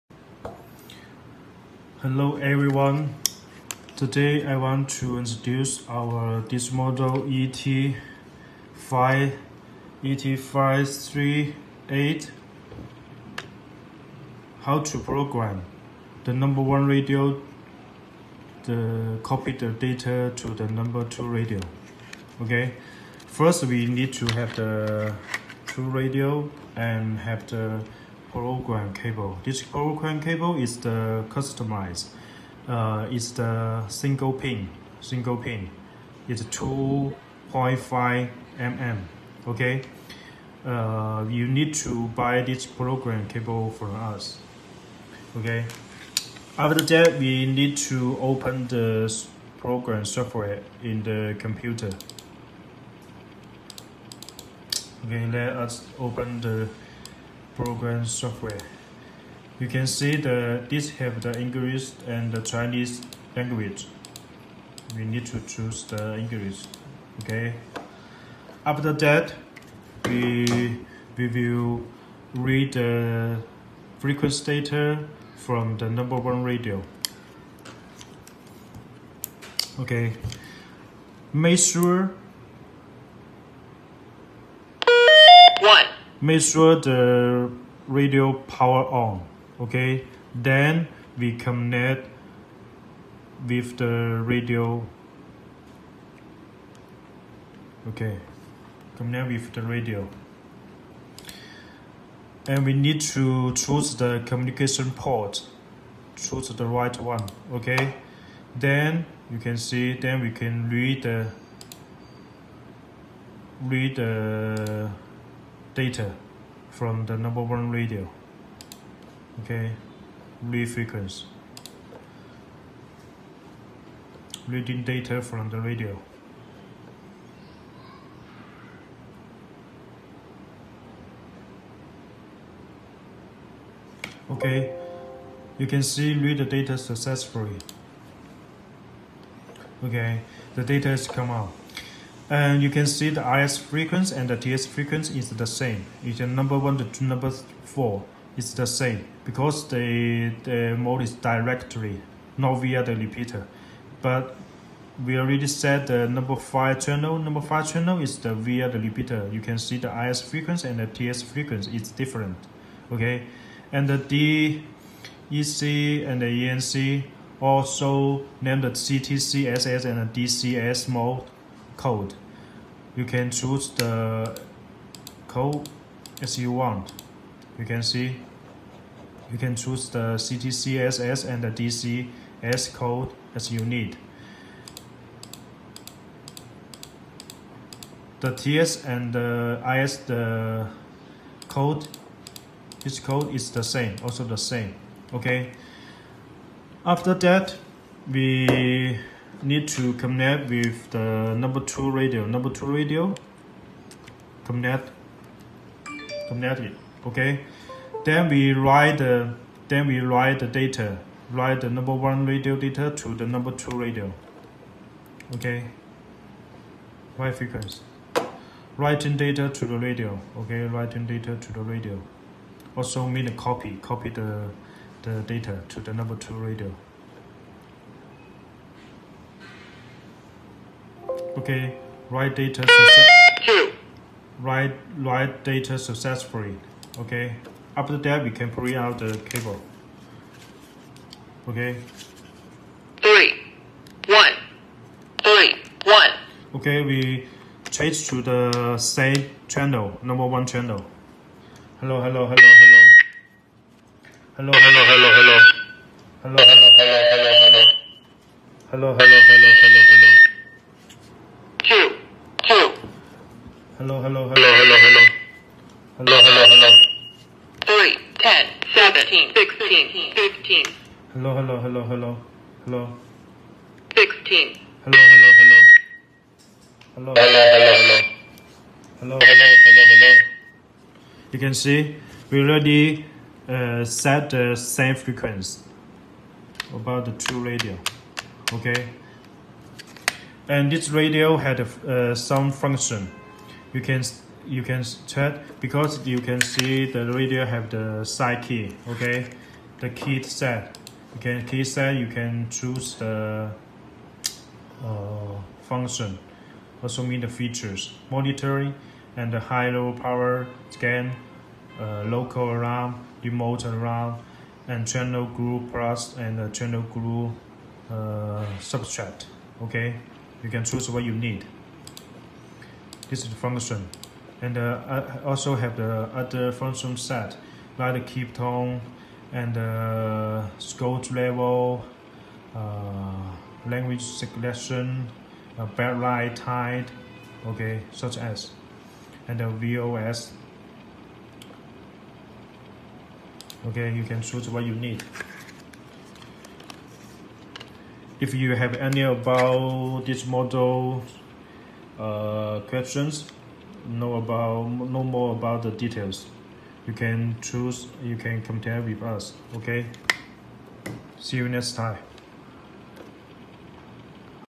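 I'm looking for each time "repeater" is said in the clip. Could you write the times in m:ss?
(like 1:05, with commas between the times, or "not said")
2:32, 2:38.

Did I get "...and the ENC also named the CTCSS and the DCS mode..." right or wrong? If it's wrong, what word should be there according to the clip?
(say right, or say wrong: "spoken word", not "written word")
right.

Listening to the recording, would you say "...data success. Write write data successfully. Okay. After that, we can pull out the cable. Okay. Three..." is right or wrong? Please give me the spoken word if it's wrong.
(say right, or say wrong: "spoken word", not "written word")
right.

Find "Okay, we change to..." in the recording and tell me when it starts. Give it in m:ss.
4:06.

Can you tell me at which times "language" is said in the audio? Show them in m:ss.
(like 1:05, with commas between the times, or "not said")
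1:03, 5:33.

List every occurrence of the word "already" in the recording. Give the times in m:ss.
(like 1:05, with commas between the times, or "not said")
2:35, 4:42.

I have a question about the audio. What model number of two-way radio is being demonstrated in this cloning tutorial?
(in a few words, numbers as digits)
ET538.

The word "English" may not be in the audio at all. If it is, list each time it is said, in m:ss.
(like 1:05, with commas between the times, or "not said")
1:01, 1:06.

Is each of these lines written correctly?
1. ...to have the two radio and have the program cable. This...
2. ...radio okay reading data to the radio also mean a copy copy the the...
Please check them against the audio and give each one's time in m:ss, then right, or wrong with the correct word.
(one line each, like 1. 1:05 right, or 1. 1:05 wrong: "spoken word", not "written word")
1. 0:24 right
2. 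3:39 wrong: "writing", not "reading".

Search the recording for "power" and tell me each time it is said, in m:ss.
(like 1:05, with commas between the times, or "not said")
1:28, 5:09.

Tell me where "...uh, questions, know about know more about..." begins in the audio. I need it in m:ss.
5:51.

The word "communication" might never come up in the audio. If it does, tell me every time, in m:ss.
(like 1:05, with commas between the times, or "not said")
1:44.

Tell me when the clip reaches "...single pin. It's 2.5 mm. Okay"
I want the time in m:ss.
0:35.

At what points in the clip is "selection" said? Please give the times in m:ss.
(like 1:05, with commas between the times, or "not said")
5:34.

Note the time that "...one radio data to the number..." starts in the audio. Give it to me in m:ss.
3:31.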